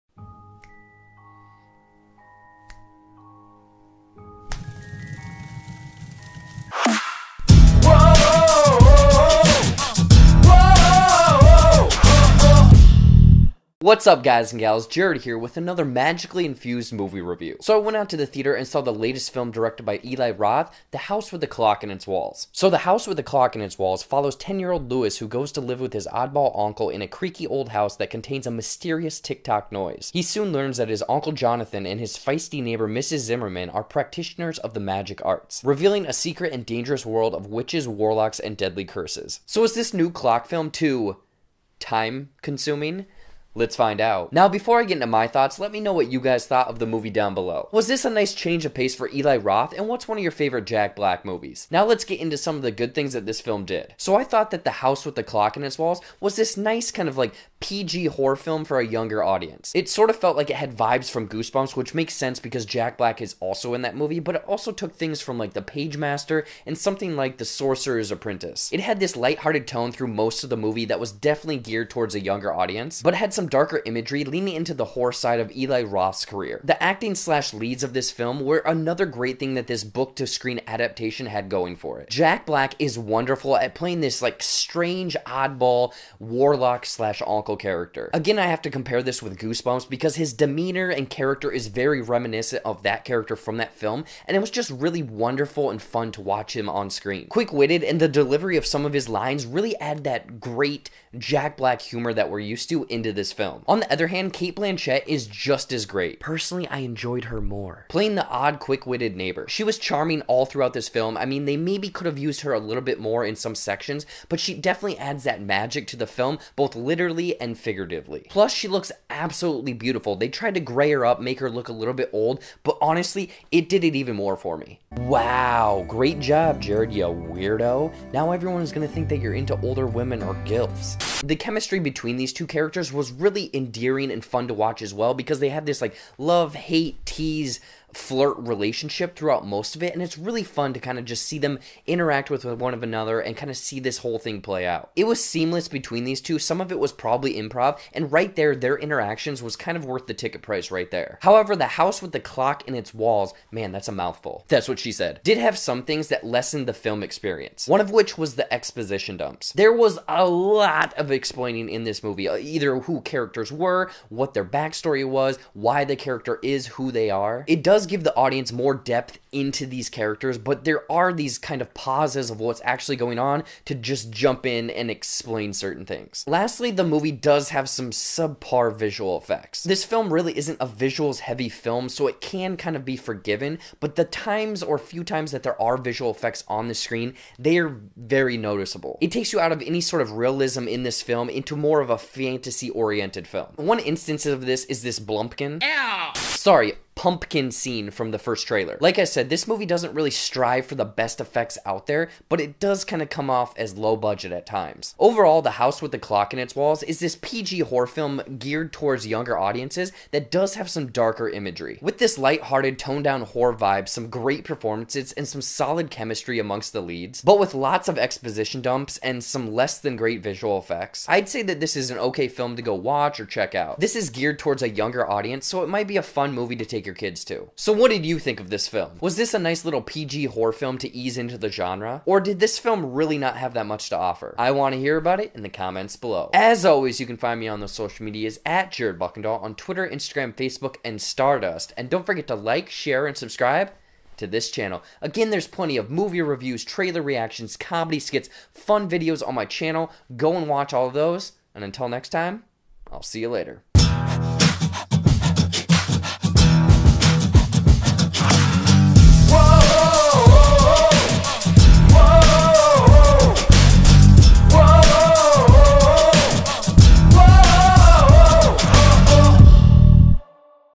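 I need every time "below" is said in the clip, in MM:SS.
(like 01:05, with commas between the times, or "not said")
00:47, 03:55.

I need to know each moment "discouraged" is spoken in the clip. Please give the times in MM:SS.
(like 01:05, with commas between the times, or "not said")
not said.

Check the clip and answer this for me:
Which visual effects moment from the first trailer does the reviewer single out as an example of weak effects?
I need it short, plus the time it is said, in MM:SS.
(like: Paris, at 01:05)
pumpkin scene, at 03:17.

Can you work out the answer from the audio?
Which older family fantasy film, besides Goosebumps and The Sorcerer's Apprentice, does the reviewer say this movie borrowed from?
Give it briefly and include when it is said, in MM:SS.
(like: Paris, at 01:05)
The Pagemaster, at 01:05.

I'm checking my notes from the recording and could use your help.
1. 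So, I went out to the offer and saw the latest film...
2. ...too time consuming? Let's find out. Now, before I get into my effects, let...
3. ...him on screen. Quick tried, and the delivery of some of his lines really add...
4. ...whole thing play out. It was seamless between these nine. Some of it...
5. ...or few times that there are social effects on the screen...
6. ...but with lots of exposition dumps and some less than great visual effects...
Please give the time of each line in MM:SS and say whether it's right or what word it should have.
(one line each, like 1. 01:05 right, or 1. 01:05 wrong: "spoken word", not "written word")
1. 00:17 wrong: "theater", not "offer"
2. 00:40 wrong: "thoughts", not "effects"
3. 01:36 wrong: "witted", not "tried"
4. 02:23 wrong: "two", not "nine"
5. 03:04 wrong: "visual", not "social"
6. 03:37 right.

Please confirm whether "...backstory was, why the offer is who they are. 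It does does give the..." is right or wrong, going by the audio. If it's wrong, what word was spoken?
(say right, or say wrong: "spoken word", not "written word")
wrong: "character", not "offer".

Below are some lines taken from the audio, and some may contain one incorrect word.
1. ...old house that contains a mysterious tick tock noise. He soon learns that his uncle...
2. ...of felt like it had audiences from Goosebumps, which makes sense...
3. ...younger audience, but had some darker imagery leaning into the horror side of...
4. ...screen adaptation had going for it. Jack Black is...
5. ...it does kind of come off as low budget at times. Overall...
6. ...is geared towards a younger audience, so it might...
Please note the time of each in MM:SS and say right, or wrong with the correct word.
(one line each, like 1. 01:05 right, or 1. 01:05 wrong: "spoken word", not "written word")
1. 00:27 right
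2. 01:00 wrong: "vibes", not "audiences"
3. 01:12 right
4. 01:20 right
5. 03:22 right
6. 03:43 right.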